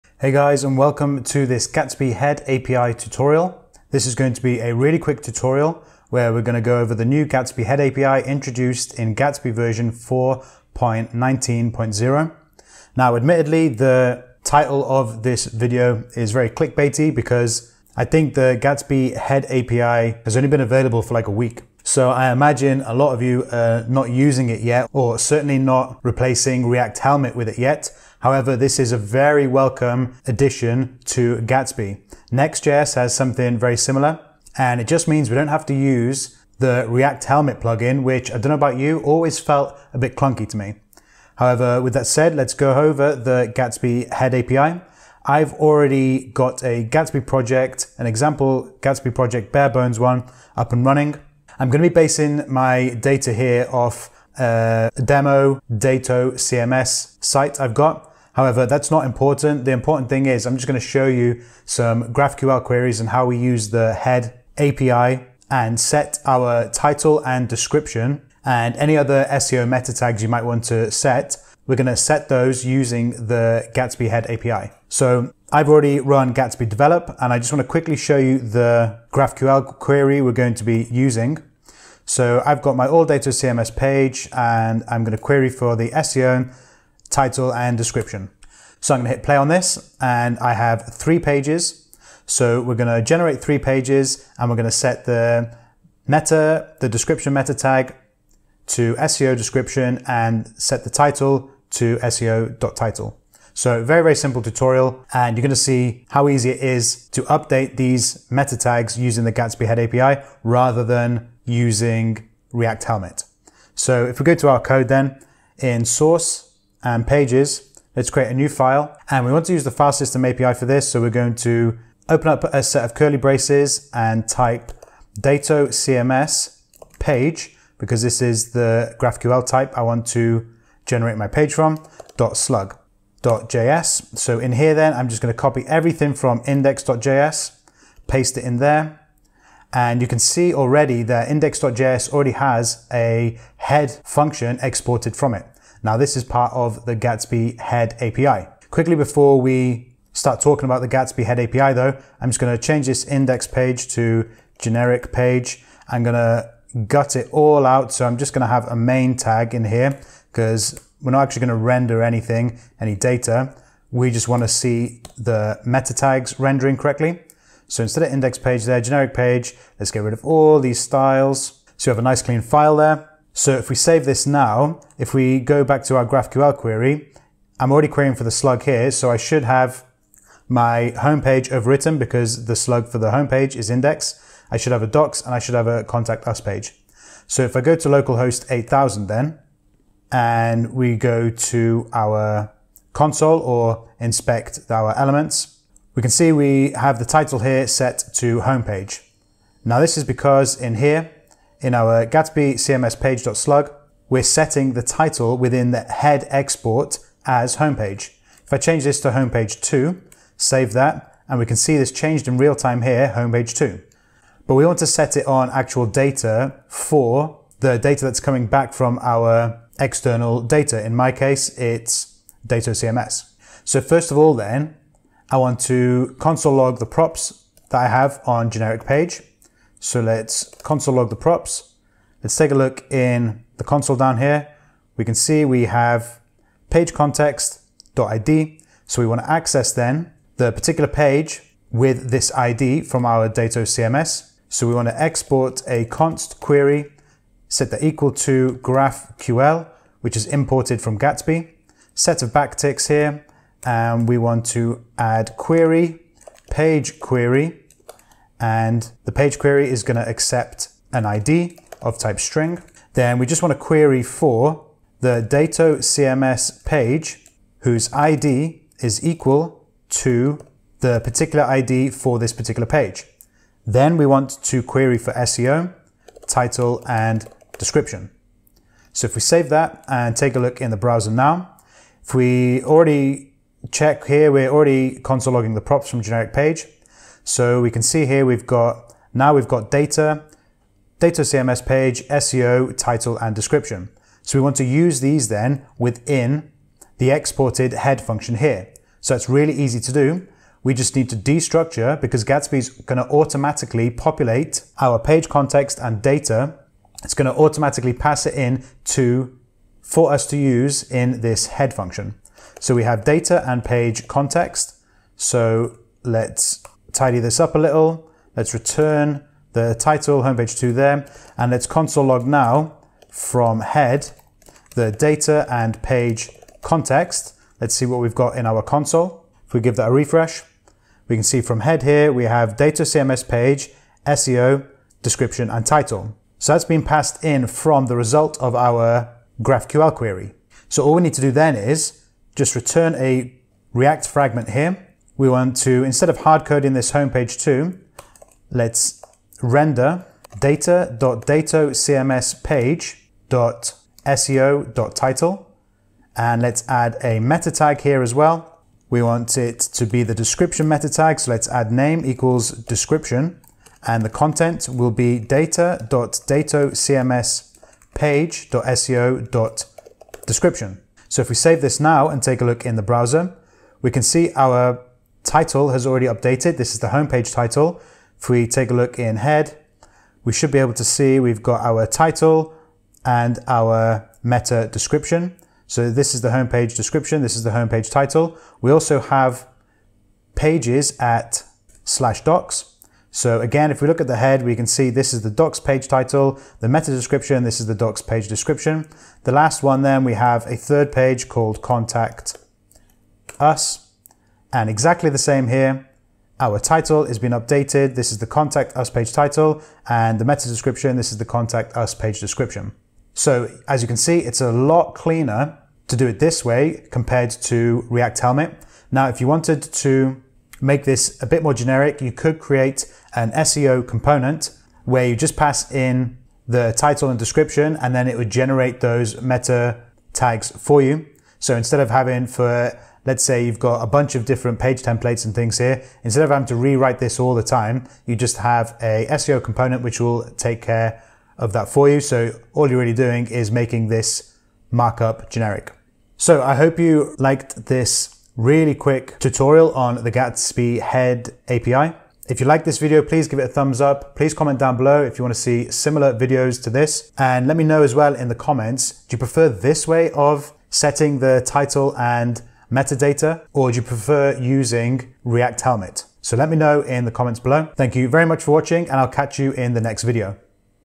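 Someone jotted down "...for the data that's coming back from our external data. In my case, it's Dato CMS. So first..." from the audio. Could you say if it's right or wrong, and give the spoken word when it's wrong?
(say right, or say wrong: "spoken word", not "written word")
right.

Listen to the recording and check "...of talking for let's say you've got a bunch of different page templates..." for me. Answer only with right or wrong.
wrong.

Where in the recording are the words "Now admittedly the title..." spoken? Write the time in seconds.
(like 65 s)
12 s.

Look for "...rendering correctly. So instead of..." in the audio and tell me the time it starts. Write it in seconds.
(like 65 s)
166 s.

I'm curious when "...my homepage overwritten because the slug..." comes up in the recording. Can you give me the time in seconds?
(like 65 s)
180 s.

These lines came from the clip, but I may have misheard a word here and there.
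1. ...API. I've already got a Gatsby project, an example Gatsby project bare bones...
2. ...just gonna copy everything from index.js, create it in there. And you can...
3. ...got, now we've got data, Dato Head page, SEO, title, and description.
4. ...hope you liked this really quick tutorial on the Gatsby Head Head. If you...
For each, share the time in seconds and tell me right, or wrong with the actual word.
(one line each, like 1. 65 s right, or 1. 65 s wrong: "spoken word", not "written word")
1. 44 s right
2. 135 s wrong: "paste", not "create"
3. 288 s wrong: "CMS", not "Head"
4. 446 s wrong: "API", not "Head".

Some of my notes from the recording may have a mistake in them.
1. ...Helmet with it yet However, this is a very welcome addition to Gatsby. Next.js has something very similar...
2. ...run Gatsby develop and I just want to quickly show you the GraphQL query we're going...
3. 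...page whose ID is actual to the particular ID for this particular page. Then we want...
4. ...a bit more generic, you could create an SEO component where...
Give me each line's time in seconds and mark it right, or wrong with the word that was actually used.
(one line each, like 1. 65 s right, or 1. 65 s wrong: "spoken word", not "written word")
1. 26 s right
2. 75 s right
3. 266 s wrong: "equal", not "actual"
4. 421 s right.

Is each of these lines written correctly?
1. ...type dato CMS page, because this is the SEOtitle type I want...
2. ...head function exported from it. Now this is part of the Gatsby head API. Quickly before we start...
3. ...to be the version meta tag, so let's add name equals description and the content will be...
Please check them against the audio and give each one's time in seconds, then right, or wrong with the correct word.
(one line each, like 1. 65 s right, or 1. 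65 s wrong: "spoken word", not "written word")
1. 124 s wrong: "GraphQL", not "SEOtitle"
2. 143 s right
3. 359 s wrong: "description", not "version".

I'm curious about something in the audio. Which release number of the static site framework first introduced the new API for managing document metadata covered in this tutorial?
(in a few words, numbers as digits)
4.19.0.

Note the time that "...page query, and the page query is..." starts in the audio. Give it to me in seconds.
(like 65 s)
256 s.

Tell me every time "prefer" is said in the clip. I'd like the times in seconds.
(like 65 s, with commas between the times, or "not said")
459 s, 463 s.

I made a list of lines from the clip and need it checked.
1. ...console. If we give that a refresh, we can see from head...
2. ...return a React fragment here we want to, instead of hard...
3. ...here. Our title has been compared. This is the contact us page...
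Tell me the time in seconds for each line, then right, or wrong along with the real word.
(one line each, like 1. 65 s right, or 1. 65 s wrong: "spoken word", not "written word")
1. 328 s right
2. 342 s right
3. 405 s wrong: "updated", not "compared".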